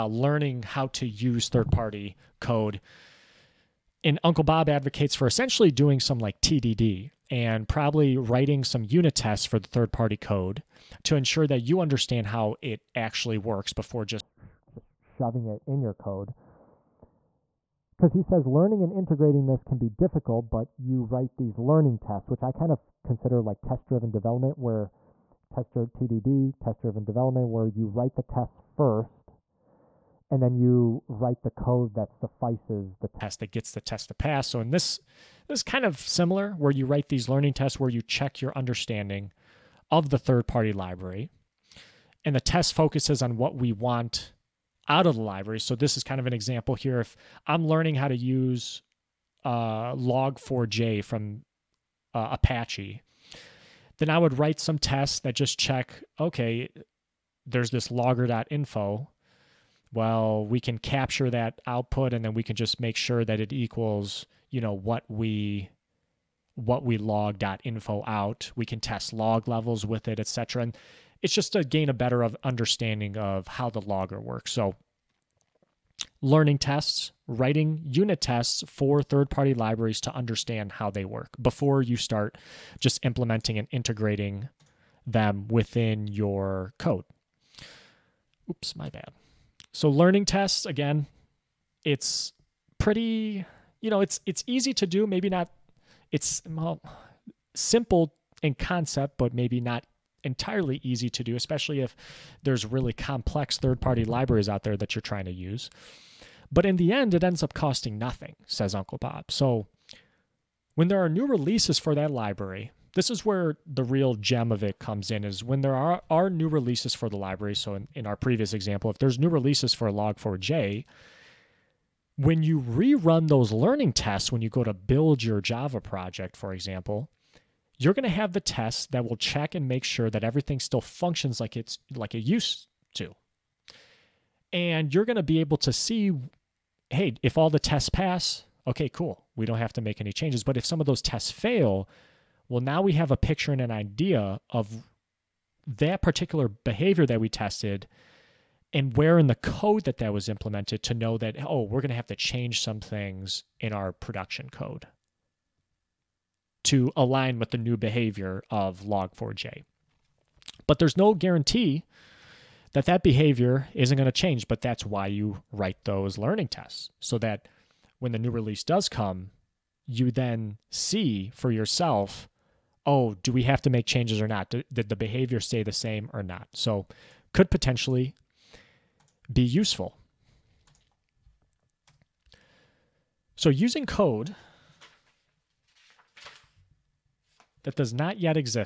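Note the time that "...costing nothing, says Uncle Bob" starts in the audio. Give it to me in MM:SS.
01:47.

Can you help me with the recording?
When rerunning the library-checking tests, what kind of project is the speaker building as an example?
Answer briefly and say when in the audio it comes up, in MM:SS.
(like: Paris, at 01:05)
Java project, at 02:05.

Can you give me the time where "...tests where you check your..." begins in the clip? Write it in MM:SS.
00:37.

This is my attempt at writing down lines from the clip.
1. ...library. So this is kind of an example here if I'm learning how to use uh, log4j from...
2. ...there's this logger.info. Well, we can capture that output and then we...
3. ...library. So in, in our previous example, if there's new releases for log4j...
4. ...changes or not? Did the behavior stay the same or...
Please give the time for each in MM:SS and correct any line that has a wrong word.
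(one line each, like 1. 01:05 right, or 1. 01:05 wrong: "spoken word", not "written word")
1. 00:45 right
2. 00:57 right
3. 01:57 right
4. 02:53 right.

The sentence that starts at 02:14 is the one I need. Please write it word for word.
And you're going to be able to see hey, if all the tests pass, okay, cool.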